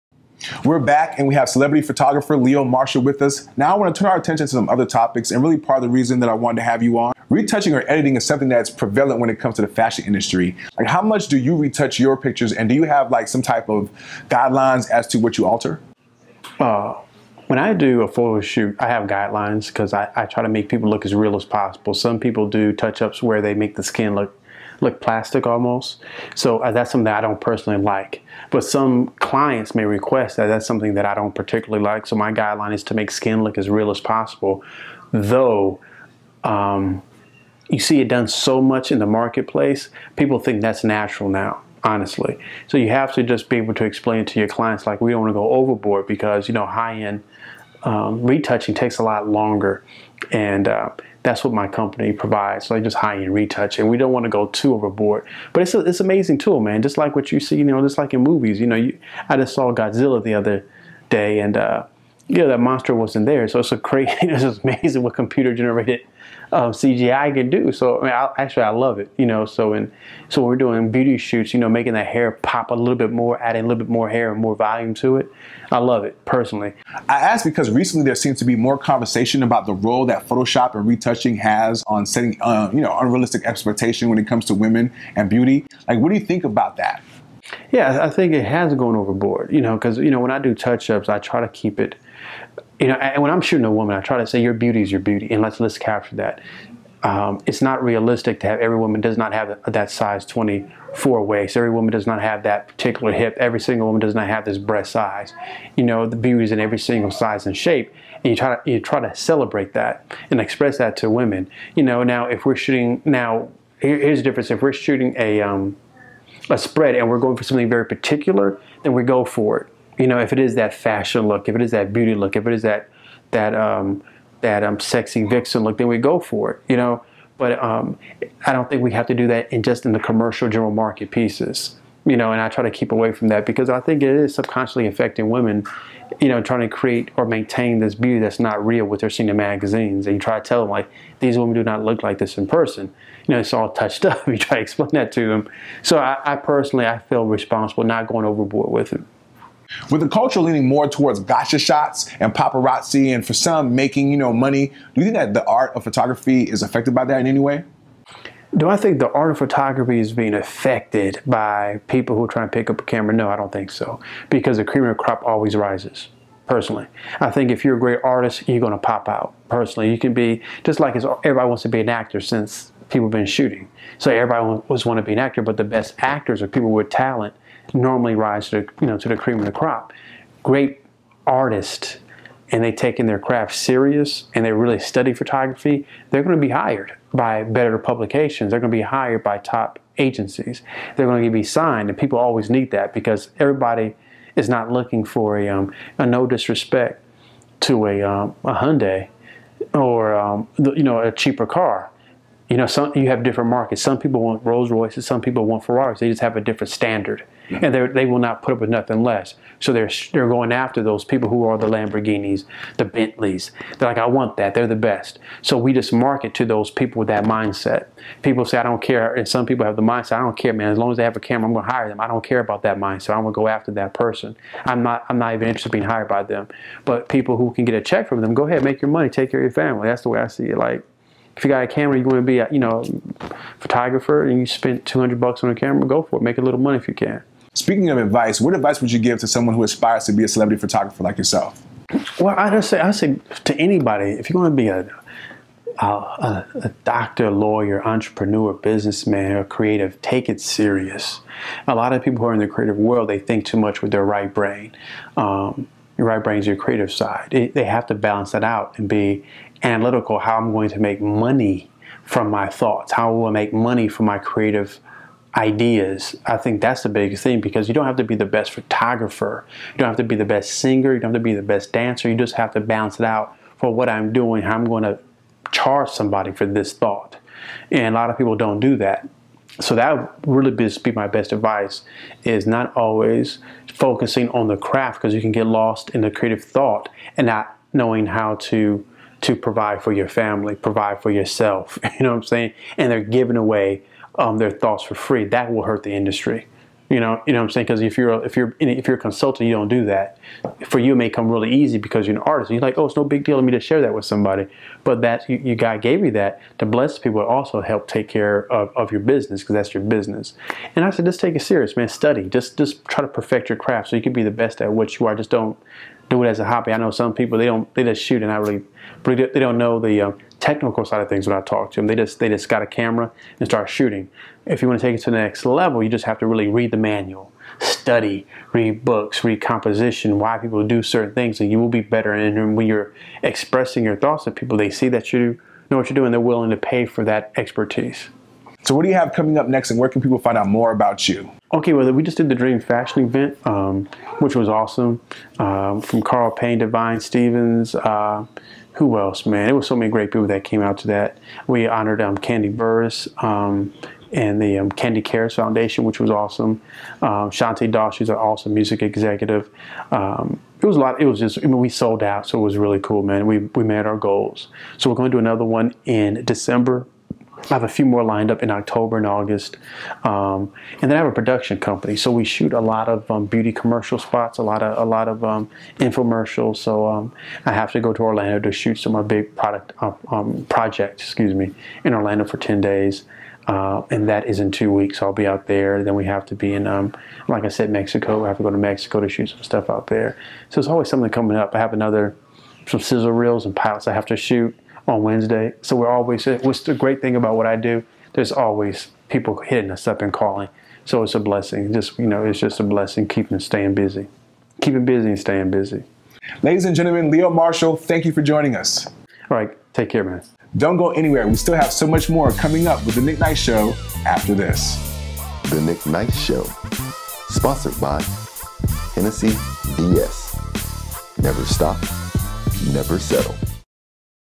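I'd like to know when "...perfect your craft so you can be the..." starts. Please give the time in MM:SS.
05:13.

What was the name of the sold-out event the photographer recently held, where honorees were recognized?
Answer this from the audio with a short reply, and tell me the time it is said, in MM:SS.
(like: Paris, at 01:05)
Dream Fashion, at 05:42.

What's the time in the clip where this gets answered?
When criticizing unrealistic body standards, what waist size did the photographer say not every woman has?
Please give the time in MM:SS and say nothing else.
01:39.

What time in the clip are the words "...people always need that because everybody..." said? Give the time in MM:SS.
03:11.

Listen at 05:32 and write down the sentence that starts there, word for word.
And when you're expressing your thoughts to people, they see that you know what you're doing.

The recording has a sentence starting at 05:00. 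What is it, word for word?
For you, it may come really easy because you're an artist.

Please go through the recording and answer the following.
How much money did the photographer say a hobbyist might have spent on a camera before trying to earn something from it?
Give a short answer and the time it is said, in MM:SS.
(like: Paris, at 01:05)
$200, at 03:54.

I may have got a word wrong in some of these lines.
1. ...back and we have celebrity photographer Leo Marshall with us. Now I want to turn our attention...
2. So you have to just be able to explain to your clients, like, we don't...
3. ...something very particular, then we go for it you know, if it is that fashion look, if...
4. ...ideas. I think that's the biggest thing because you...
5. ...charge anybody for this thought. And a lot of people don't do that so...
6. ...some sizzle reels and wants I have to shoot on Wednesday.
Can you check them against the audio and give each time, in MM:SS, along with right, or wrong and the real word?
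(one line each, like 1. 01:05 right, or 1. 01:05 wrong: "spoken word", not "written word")
1. 00:00 right
2. 00:42 right
3. 01:57 right
4. 04:25 right
5. 04:35 wrong: "somebody", not "anybody"
6. 06:32 wrong: "pilots", not "wants".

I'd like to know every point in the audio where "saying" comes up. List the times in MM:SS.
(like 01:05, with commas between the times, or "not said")
04:52, 04:57.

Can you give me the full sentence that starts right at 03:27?
and they will not put up with nothing less.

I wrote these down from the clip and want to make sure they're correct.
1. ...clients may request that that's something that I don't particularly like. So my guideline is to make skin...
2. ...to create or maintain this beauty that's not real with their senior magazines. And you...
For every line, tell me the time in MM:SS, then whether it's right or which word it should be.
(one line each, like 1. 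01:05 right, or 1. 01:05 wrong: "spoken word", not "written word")
1. 00:29 right
2. 02:16 right.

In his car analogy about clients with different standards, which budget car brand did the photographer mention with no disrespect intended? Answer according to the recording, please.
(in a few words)
Hyundai.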